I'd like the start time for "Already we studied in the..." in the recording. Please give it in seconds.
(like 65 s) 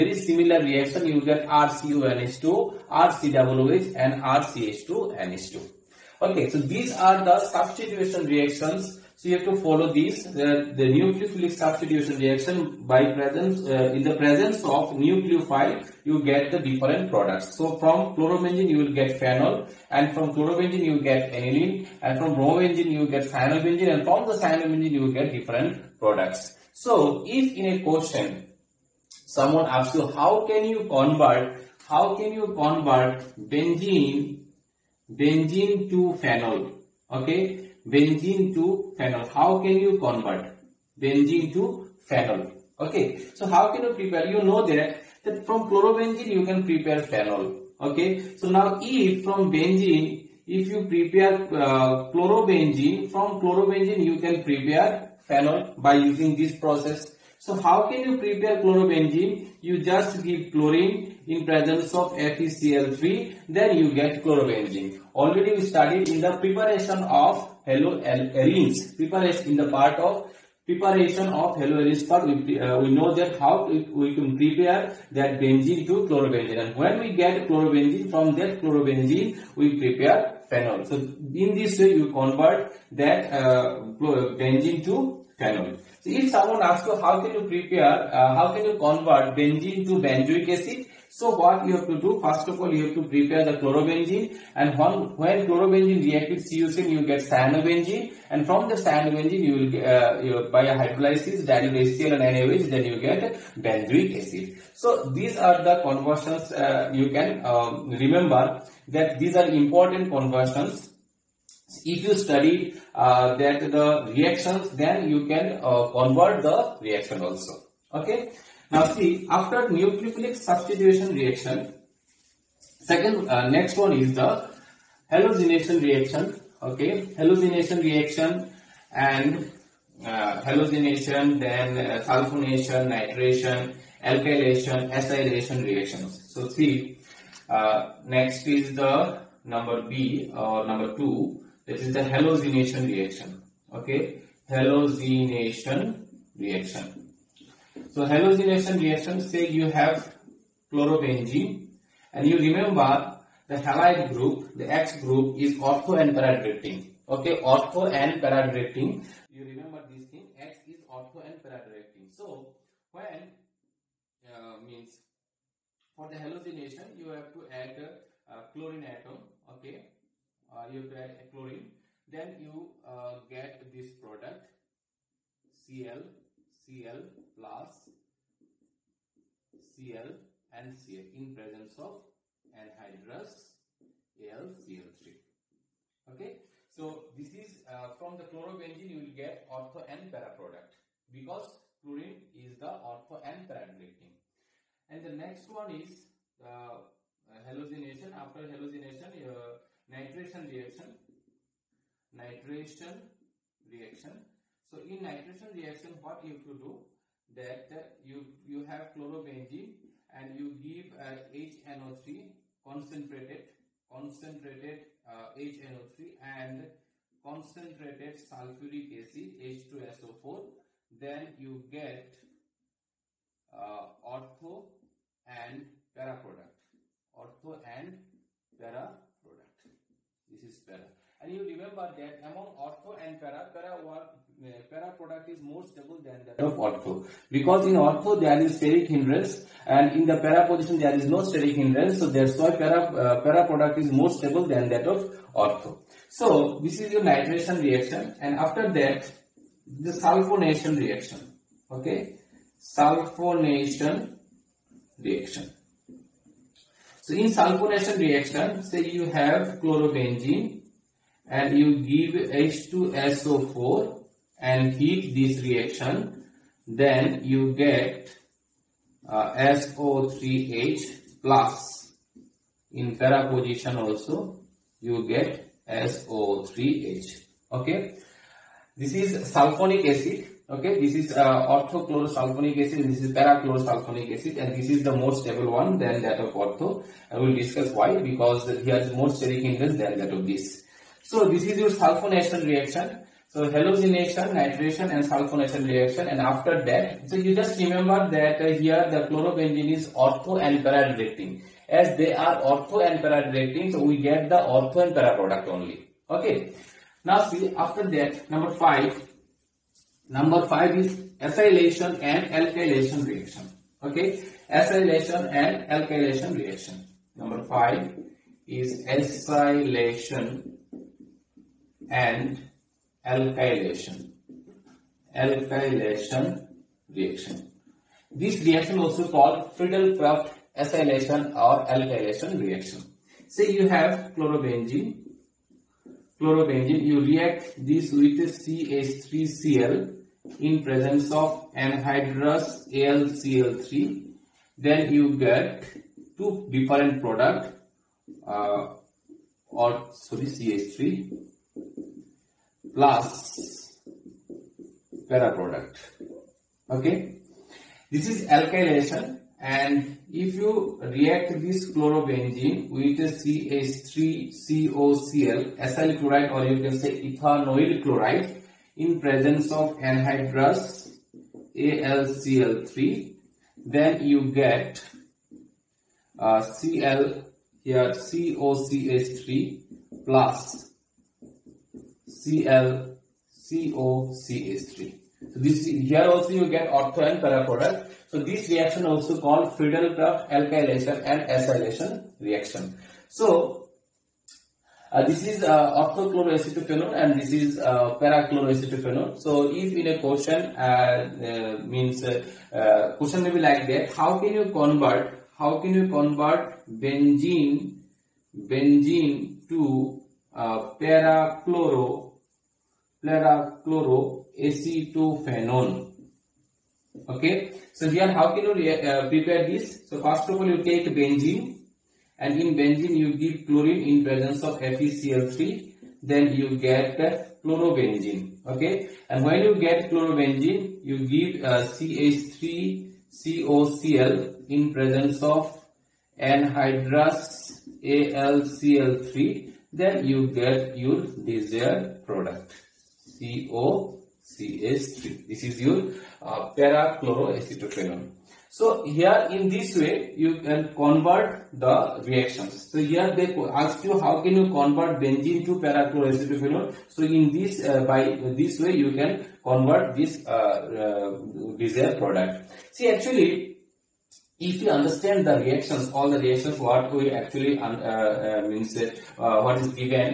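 65 s.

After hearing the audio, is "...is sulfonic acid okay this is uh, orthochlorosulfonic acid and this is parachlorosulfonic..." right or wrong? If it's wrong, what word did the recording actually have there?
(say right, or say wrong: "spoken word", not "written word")
right.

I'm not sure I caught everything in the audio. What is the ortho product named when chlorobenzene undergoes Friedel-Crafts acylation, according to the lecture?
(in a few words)
orthochloroacetophenone.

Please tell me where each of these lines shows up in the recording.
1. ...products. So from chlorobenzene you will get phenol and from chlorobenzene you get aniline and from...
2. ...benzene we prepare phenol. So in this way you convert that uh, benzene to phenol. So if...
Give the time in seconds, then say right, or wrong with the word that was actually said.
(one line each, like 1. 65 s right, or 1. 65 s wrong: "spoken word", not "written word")
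1. 17 s right
2. 78 s wrong: "chlorobenzene", not "benzene".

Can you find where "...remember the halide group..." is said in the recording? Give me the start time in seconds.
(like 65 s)
152 s.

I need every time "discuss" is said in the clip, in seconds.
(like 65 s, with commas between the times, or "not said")
287 s.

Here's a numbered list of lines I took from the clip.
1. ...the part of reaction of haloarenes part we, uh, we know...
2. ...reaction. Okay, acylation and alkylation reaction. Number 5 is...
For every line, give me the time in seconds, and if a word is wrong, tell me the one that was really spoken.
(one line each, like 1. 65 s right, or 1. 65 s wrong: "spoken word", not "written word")
1. 69 s wrong: "preparation", not "reaction"
2. 313 s right.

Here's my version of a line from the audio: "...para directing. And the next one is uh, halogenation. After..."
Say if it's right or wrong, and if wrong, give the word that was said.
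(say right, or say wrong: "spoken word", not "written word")
right.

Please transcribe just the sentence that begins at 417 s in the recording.
Okay, so here how can you prepare this?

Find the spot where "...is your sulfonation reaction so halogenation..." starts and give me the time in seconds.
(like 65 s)
291 s.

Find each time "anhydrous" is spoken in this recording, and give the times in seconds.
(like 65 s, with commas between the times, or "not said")
182 s, 341 s, 369 s, 436 s.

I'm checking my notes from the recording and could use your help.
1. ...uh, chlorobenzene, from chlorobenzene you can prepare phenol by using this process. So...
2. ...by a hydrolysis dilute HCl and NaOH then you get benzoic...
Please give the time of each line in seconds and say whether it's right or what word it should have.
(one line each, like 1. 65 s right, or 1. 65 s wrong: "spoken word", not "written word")
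1. 51 s right
2. 100 s right.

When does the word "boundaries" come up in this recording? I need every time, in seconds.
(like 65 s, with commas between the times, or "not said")
not said.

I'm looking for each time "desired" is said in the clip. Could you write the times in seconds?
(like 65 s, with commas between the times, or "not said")
441 s, 461 s.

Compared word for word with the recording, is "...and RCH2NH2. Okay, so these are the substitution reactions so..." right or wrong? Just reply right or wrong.
right.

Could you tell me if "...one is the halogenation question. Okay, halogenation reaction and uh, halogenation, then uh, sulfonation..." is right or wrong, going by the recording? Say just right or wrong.
wrong.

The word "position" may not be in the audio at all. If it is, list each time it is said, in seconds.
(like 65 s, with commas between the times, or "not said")
240 s, 273 s.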